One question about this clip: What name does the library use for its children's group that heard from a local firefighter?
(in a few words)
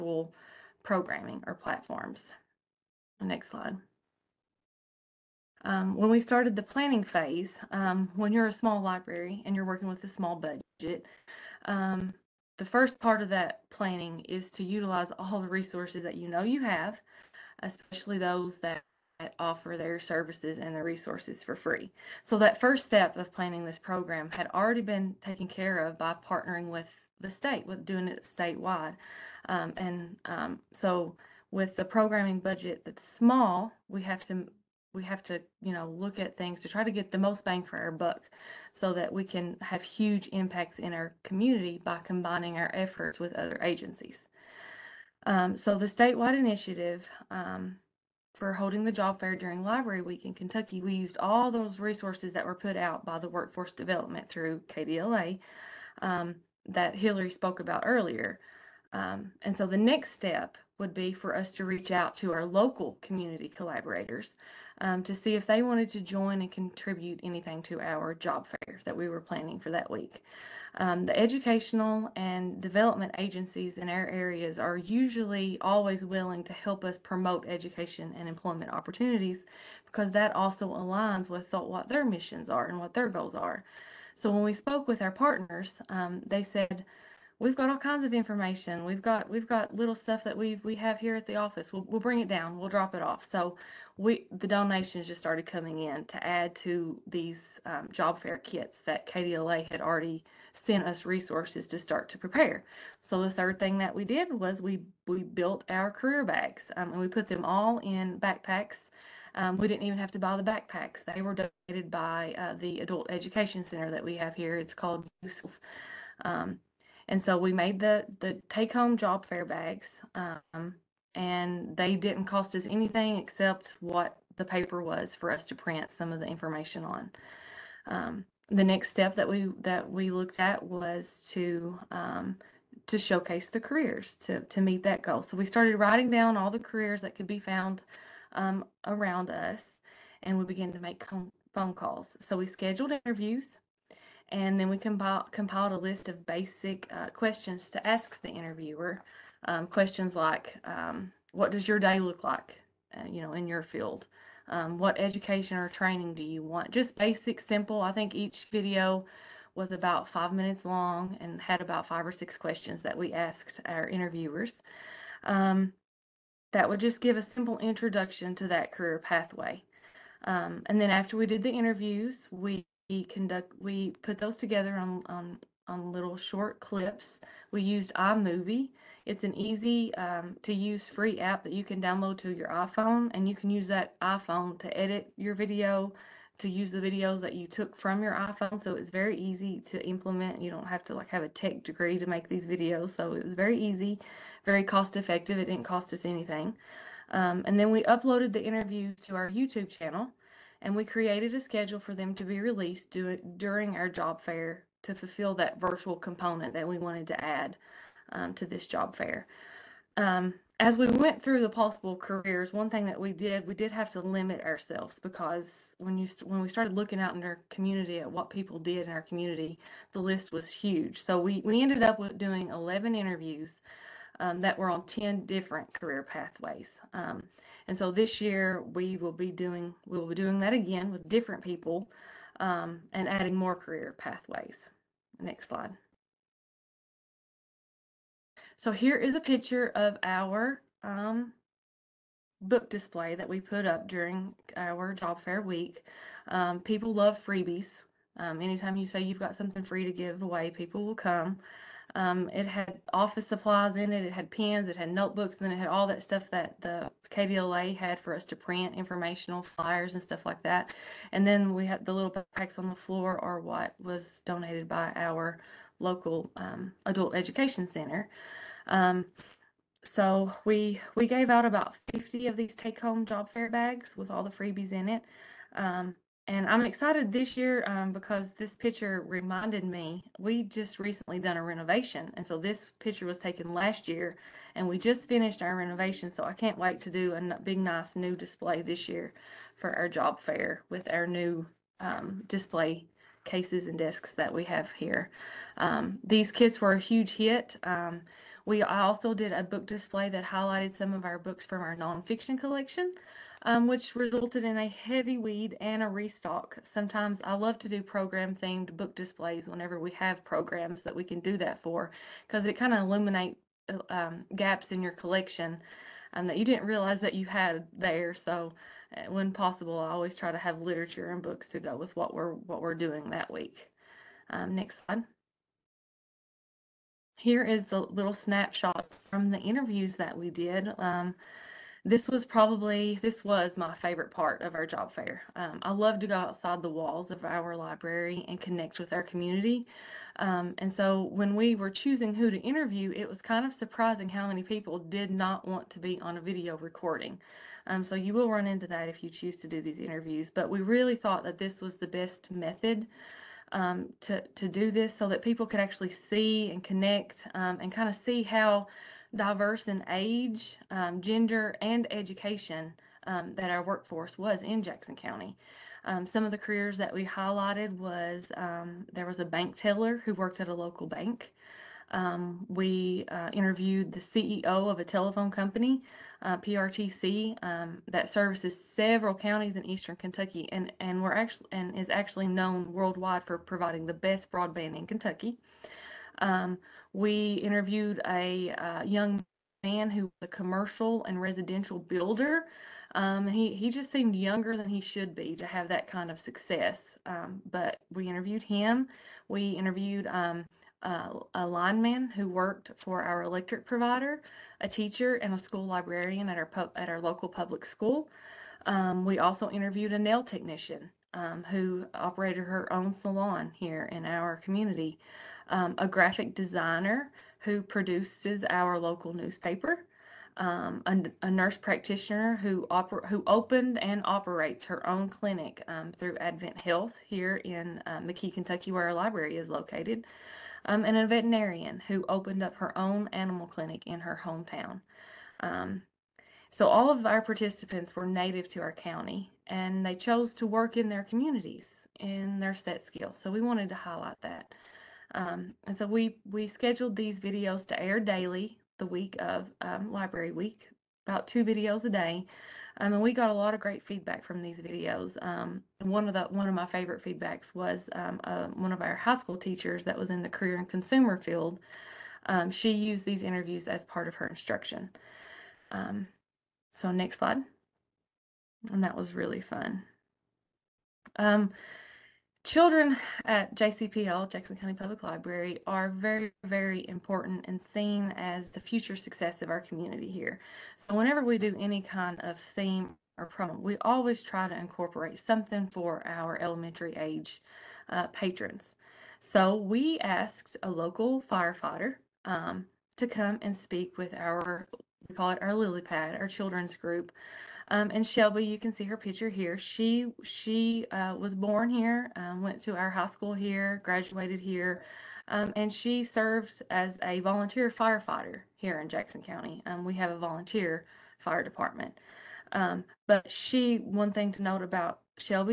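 lily pad.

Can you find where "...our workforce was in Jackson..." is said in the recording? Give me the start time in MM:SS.
06:03.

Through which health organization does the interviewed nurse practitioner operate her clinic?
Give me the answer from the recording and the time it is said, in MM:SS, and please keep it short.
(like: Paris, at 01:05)
Advent Health, at 07:06.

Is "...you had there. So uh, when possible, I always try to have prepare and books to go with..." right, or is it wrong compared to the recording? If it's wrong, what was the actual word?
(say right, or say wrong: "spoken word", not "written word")
wrong: "literature", not "prepare".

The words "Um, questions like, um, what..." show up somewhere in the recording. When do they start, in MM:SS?
02:29.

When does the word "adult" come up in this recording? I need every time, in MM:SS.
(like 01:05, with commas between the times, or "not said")
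01:52, 04:26.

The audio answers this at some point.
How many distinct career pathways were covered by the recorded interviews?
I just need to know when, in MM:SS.
03:44.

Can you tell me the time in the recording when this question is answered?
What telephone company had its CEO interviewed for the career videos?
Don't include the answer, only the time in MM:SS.
06:16.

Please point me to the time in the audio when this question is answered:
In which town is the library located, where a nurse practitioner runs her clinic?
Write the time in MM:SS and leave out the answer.
07:08.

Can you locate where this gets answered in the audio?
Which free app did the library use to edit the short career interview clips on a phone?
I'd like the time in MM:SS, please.
02:57.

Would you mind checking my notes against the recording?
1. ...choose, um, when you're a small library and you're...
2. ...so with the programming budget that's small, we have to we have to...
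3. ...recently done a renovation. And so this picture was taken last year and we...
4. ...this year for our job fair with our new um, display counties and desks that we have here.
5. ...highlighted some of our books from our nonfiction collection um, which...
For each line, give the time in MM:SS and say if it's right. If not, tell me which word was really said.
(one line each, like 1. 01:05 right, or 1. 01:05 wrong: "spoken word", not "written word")
1. 00:07 wrong: "phase", not "choose"
2. 00:30 right
3. 04:40 right
4. 04:48 wrong: "cases", not "counties"
5. 05:00 right.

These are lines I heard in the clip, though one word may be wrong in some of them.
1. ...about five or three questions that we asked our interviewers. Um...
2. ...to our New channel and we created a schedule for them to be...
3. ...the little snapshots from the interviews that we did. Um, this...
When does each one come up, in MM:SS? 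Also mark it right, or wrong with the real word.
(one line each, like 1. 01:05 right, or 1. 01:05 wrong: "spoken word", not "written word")
1. 02:41 wrong: "six", not "three"
2. 03:19 wrong: "YouTube", not "New"
3. 05:27 right.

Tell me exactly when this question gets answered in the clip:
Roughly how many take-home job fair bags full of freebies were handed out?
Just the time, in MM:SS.
04:31.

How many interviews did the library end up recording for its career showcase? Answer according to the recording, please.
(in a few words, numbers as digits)
11.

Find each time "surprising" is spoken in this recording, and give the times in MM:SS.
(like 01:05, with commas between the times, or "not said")
05:43.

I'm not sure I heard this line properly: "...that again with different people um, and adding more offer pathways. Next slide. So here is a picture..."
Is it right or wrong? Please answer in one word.
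wrong.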